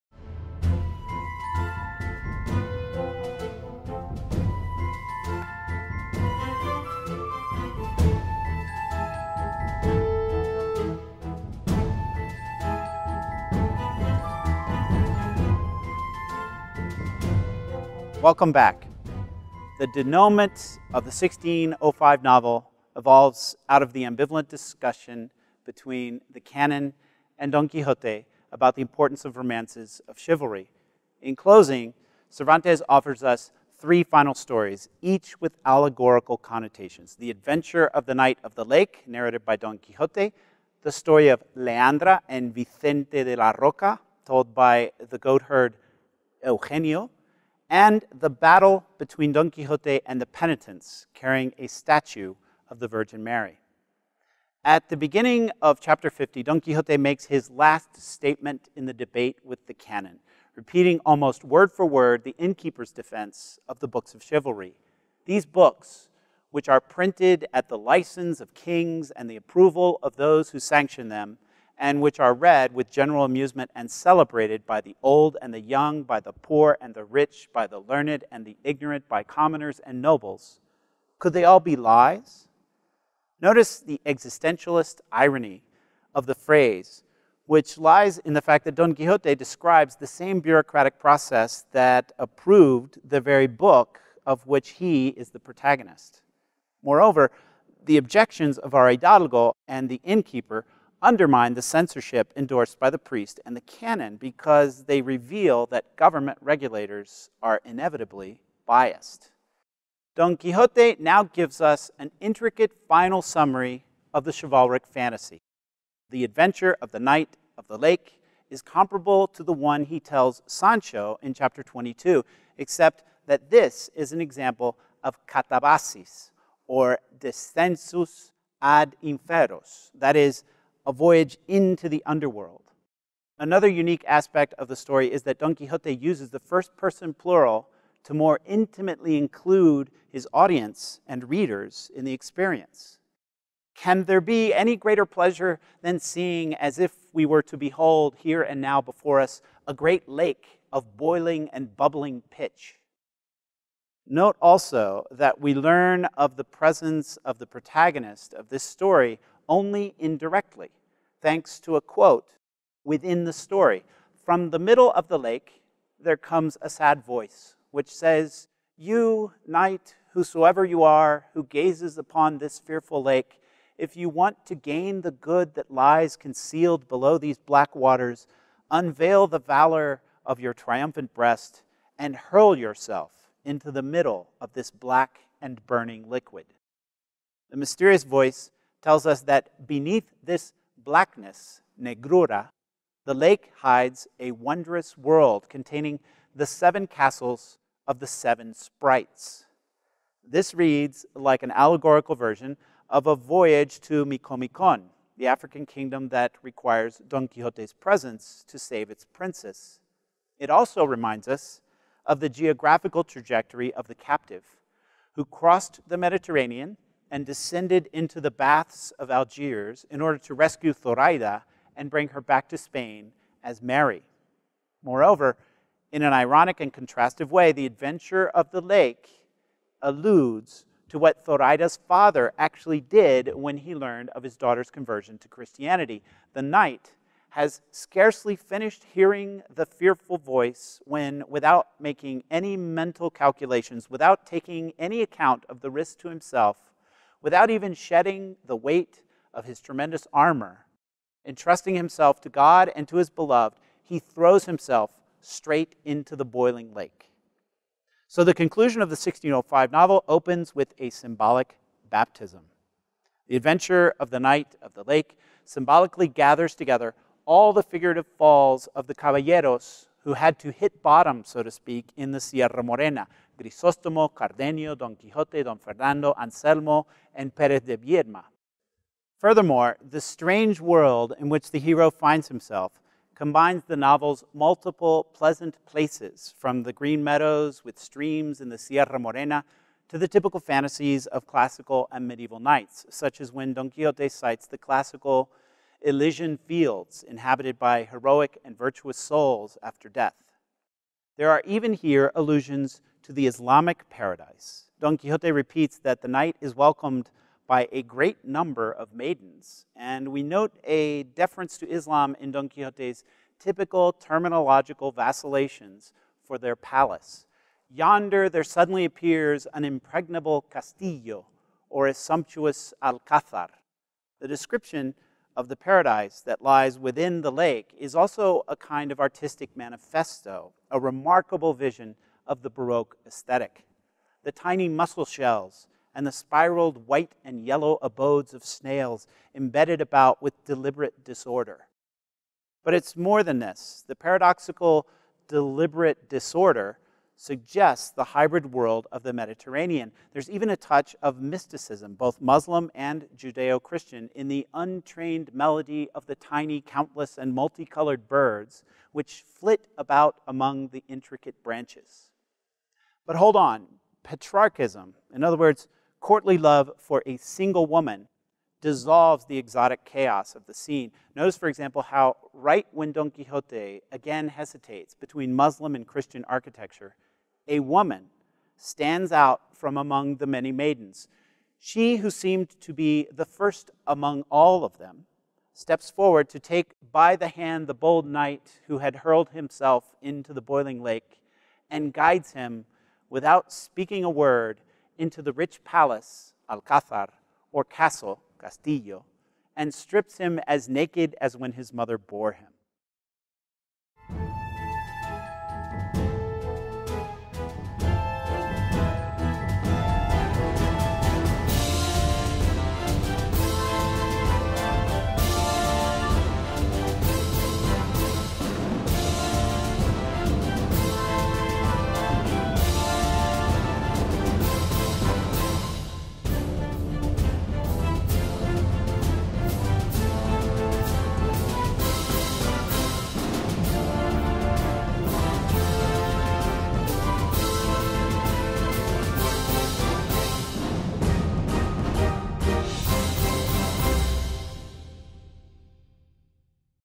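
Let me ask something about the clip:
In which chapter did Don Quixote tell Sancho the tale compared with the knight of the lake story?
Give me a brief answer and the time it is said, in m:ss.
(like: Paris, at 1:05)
22, at 2:01.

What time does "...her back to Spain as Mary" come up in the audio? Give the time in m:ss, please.
3:42.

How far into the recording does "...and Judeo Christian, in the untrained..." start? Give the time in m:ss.
5:52.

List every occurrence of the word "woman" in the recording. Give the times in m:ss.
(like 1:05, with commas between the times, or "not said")
6:07, 6:17.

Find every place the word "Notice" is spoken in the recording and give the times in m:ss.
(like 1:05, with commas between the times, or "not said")
1:23, 6:11.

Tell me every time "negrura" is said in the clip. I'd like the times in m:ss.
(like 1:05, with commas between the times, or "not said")
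3:11.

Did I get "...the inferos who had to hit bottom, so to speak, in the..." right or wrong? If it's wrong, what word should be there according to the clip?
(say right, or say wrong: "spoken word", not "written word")
wrong: "caballeros", not "inferos".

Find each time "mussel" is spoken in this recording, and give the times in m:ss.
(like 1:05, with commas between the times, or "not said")
5:34.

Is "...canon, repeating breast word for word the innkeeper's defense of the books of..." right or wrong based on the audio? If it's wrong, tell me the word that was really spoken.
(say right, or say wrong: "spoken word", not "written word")
wrong: "almost", not "breast".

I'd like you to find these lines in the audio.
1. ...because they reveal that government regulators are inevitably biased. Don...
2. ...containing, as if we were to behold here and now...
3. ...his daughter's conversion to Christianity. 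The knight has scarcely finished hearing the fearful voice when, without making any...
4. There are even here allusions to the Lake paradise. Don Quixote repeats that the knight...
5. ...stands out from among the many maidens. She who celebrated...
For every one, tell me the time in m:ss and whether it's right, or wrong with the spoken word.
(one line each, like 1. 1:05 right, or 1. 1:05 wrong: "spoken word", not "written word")
1. 1:44 right
2. 2:25 wrong: "seeing", not "containing"
3. 3:54 right
4. 5:01 wrong: "Islamic", not "Lake"
5. 6:18 wrong: "seemed", not "celebrated".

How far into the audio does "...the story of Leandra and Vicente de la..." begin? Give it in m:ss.
0:40.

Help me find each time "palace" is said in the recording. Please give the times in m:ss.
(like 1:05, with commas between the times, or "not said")
5:16, 6:35.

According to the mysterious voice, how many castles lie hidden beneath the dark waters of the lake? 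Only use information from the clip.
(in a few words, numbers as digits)
7.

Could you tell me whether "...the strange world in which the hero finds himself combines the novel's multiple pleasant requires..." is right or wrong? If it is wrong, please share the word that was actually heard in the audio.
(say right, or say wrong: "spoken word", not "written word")
wrong: "places", not "requires".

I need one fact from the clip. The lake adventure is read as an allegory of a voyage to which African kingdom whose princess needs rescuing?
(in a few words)
Micomicon.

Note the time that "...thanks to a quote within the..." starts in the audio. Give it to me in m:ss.
2:41.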